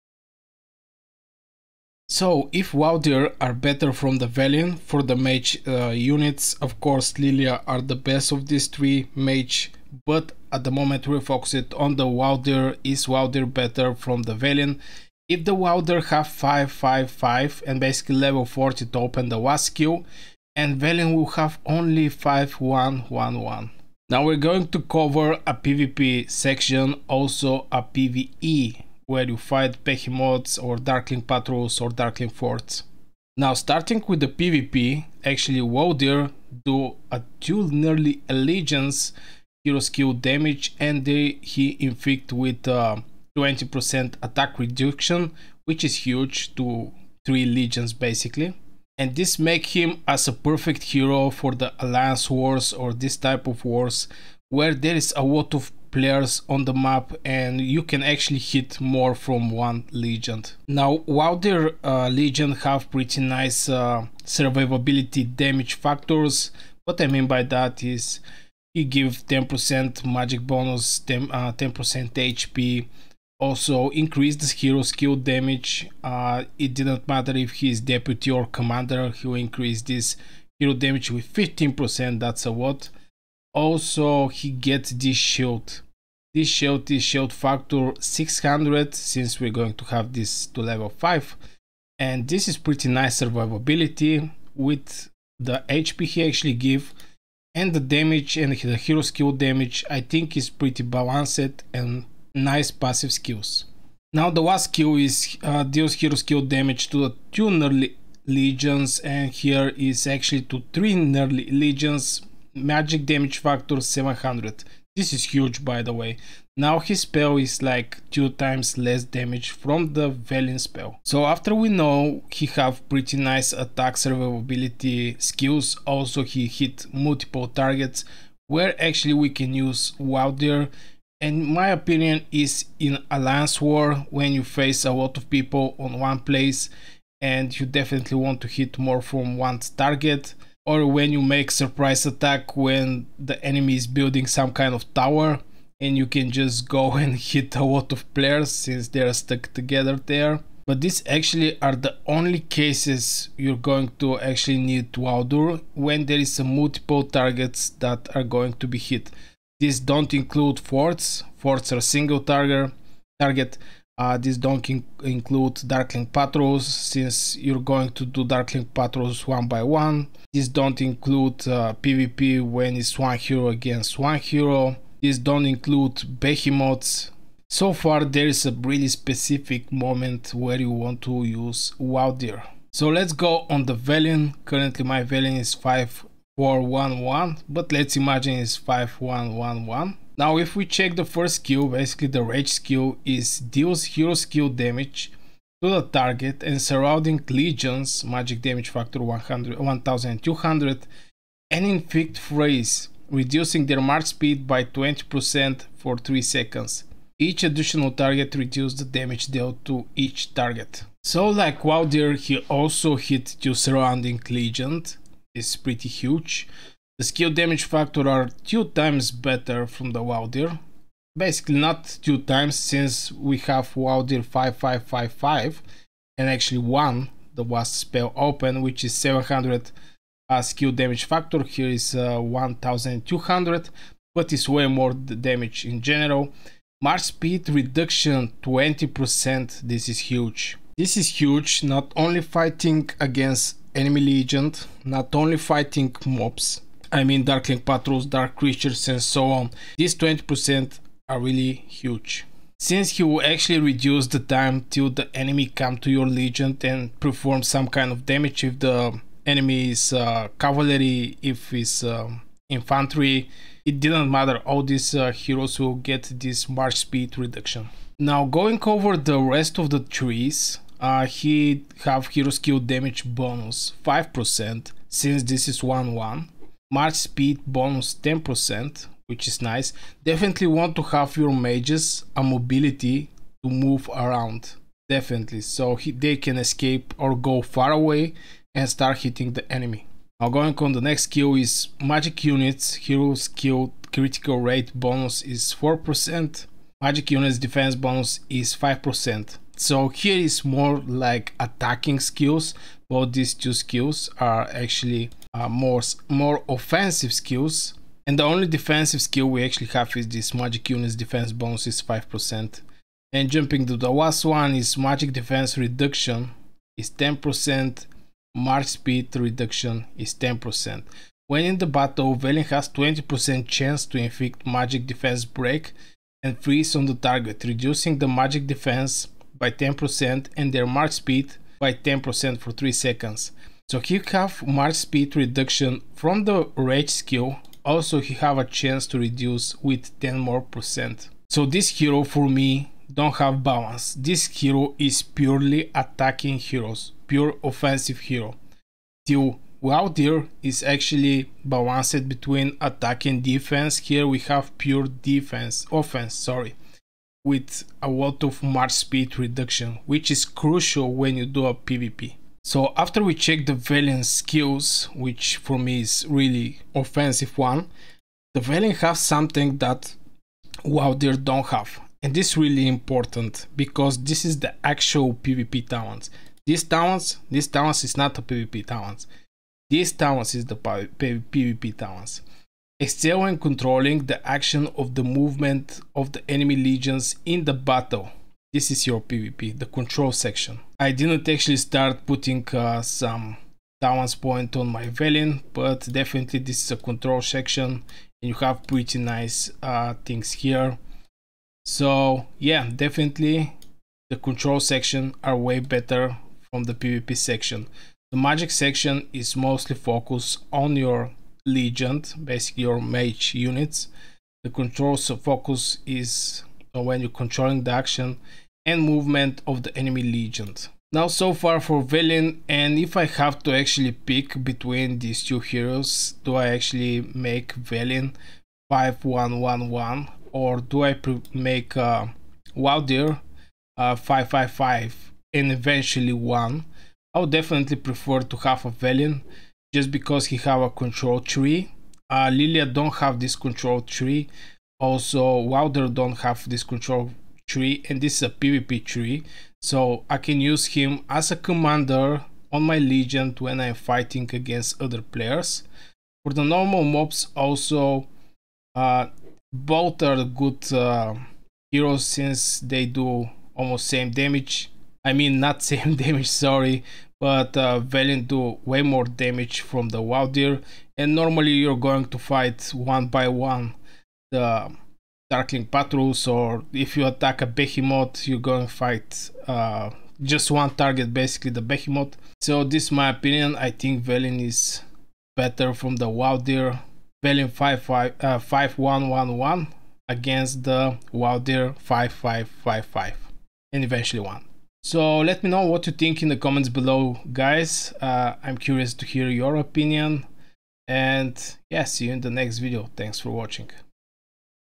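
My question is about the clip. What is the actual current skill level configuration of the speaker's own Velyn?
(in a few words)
5411.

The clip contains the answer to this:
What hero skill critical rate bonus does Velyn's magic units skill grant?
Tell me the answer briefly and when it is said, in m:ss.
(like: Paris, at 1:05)
4%, at 4:52.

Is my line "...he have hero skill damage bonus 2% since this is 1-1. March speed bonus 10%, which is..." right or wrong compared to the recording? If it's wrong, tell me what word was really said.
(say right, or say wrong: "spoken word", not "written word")
wrong: "5", not "2".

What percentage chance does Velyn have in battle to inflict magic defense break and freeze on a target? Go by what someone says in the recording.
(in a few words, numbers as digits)
20%.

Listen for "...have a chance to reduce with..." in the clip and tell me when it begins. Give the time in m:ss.
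5:38.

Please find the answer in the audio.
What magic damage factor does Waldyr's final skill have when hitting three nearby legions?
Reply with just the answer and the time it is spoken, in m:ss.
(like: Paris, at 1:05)
700, at 1:52.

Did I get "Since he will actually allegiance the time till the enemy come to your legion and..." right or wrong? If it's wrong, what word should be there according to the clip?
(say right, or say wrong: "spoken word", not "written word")
wrong: "reduce", not "allegiance".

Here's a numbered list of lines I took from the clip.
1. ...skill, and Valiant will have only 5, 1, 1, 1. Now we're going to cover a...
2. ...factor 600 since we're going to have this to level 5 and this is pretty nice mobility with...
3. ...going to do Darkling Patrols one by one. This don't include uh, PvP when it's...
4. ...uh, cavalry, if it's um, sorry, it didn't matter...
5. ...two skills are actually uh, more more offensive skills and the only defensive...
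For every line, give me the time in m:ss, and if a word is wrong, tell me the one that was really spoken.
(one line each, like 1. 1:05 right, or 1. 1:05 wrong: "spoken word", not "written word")
1. 0:19 right
2. 1:27 wrong: "survivability", not "mobility"
3. 2:47 right
4. 4:19 wrong: "infantry", not "sorry"
5. 5:03 right.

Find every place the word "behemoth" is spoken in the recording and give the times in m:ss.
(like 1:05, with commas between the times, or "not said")
0:29, 2:56, 7:57, 8:01.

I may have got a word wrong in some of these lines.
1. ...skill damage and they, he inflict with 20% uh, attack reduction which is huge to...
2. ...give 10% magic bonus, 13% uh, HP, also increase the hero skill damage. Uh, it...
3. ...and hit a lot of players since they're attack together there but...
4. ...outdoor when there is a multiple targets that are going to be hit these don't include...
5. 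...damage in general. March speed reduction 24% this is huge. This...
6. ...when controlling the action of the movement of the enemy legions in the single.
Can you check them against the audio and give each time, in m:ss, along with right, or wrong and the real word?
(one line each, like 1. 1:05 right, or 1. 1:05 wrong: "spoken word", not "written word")
1. 0:39 right
2. 1:08 wrong: "10", not "13"
3. 2:26 wrong: "stuck", not "attack"
4. 2:35 right
5. 3:54 wrong: "20", not "24"
6. 6:23 wrong: "battle", not "single".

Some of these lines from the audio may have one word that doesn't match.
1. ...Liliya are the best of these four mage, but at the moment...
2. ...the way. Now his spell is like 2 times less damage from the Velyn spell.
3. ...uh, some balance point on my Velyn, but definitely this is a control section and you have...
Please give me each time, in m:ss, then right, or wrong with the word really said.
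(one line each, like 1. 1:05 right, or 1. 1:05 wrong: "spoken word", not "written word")
1. 0:07 wrong: "three", not "four"
2. 1:55 right
3. 6:32 right.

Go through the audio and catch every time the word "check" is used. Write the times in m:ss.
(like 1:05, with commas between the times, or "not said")
3:10, 6:03.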